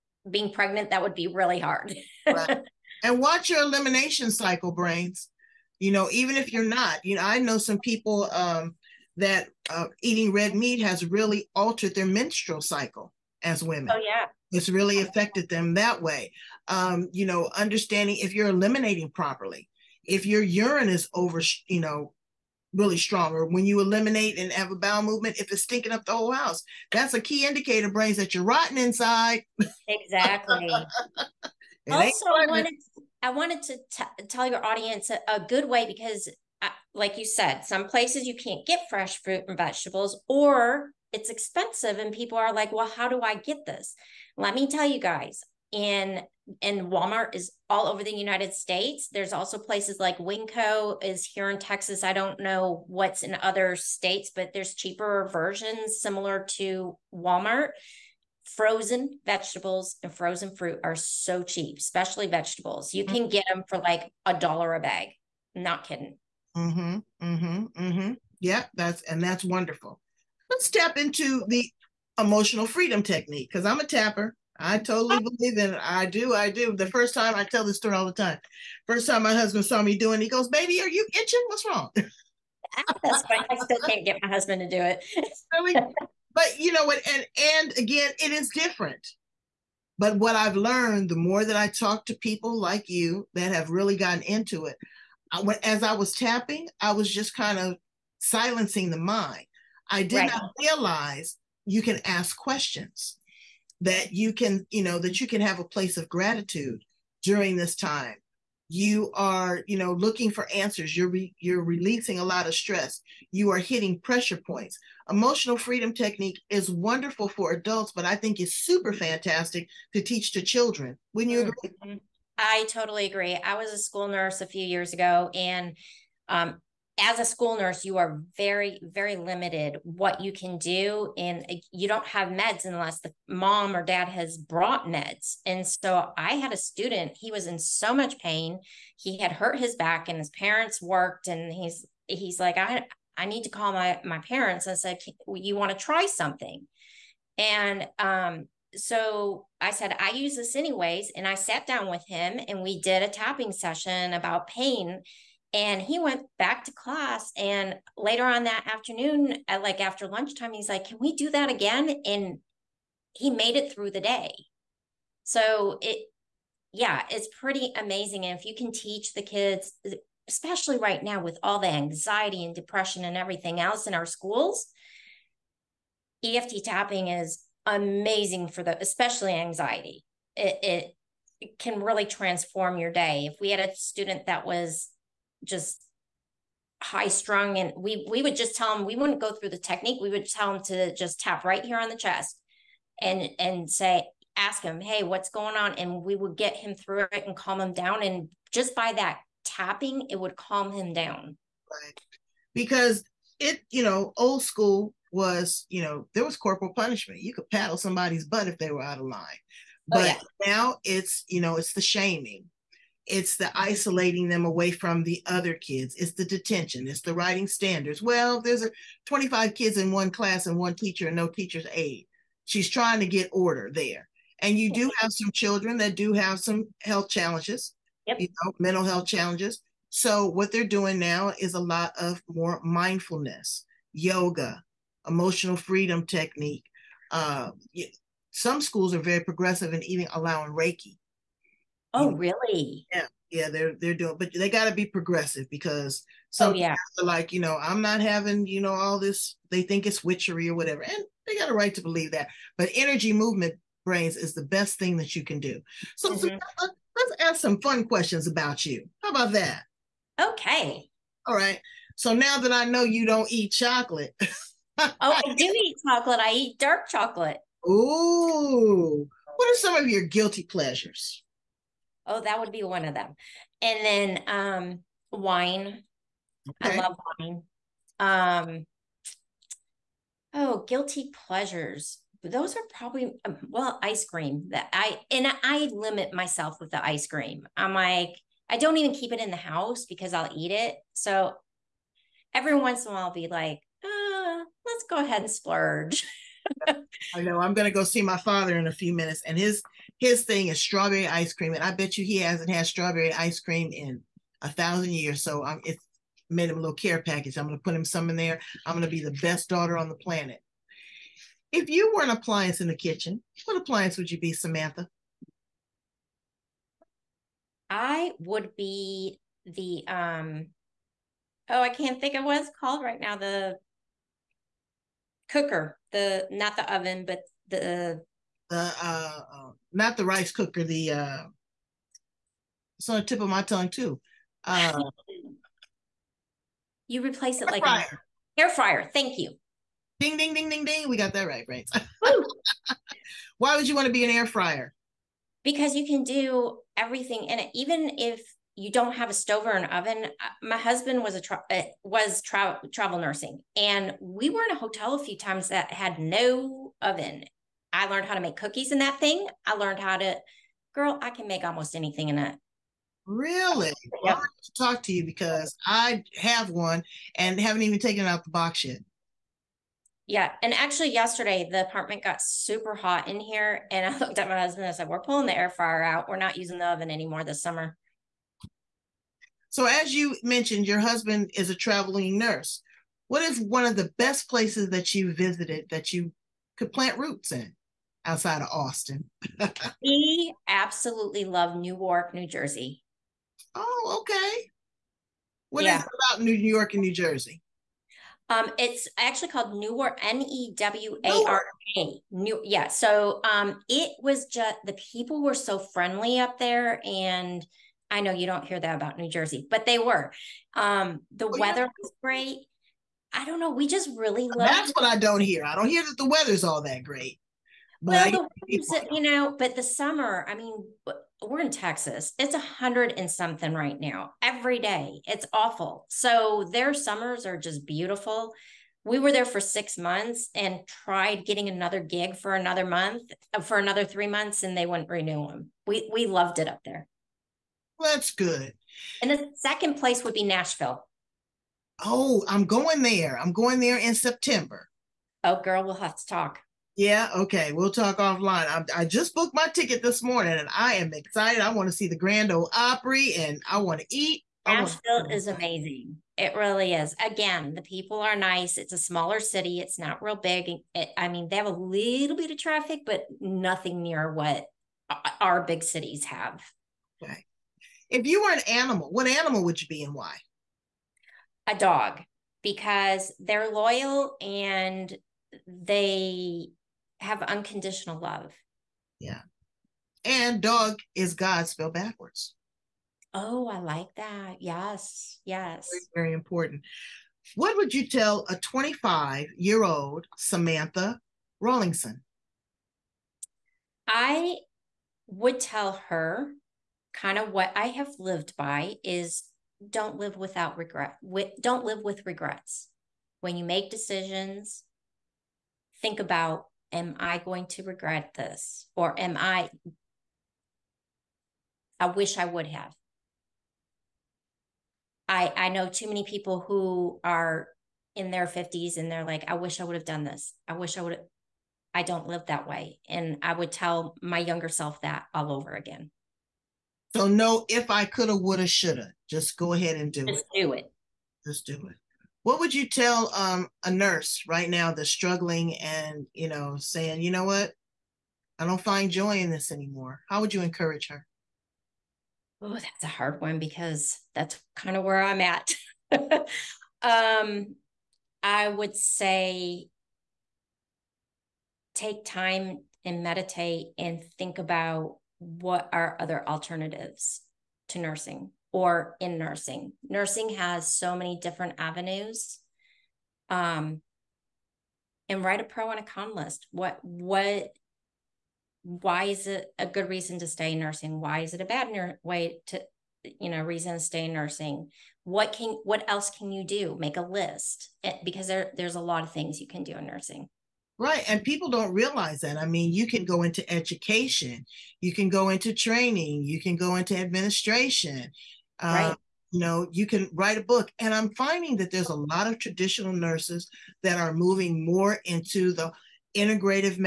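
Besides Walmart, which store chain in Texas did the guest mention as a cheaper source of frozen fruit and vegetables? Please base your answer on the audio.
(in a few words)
Winco.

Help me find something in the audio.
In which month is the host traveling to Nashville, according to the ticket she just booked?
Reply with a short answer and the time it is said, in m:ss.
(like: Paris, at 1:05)
September, at 7:23.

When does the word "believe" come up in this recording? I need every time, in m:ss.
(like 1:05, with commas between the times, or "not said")
1:15, 4:11.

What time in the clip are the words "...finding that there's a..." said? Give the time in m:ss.
9:51.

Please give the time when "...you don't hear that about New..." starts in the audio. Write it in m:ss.
6:48.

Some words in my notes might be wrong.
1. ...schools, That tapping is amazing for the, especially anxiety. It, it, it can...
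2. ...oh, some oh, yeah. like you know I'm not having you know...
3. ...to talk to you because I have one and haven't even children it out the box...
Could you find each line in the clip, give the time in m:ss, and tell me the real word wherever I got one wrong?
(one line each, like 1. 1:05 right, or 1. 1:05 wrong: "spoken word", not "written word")
1. 2:54 wrong: "EFT", not "That"
2. 4:06 right
3. 6:04 wrong: "taken", not "children".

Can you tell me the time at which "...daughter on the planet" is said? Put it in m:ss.
5:09.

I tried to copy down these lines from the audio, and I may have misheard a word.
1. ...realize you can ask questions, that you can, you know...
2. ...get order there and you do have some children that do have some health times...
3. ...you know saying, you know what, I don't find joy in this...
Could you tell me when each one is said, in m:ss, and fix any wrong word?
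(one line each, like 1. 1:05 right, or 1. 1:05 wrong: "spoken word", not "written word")
1. 1:40 right
2. 3:43 wrong: "challenges", not "times"
3. 8:56 right.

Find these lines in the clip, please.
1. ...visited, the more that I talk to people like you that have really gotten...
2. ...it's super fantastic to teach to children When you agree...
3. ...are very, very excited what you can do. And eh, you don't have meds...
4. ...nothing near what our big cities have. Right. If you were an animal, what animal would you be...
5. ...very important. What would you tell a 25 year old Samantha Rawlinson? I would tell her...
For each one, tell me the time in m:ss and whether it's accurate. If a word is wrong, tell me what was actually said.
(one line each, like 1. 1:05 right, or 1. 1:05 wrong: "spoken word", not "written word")
1. 1:30 wrong: "learned", not "visited"
2. 1:58 right
3. 2:07 wrong: "limited", not "excited"
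4. 7:43 right
5. 8:06 right.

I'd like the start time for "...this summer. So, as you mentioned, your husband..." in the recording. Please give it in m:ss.
6:17.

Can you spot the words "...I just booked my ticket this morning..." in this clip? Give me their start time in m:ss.
7:28.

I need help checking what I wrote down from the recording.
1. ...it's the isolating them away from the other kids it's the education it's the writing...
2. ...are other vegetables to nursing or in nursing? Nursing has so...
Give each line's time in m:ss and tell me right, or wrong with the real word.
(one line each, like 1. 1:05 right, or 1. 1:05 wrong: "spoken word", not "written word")
1. 3:33 wrong: "detention", not "education"
2. 9:15 wrong: "alternatives", not "vegetables".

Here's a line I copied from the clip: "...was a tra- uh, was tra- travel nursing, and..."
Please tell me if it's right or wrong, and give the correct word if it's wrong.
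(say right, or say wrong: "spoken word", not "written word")
right.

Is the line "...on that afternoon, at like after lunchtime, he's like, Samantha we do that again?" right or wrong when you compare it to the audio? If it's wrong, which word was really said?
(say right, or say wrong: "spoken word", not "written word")
wrong: "Can", not "Samantha".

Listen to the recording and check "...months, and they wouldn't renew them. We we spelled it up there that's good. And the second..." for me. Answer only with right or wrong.
wrong.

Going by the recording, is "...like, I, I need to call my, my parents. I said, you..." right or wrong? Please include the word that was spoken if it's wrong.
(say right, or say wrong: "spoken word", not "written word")
right.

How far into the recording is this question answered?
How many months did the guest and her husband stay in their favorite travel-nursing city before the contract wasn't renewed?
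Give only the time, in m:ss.
7:09.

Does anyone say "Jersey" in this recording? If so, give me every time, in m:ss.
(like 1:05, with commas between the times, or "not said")
6:32, 6:36, 6:49.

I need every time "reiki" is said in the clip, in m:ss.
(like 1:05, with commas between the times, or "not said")
4:00.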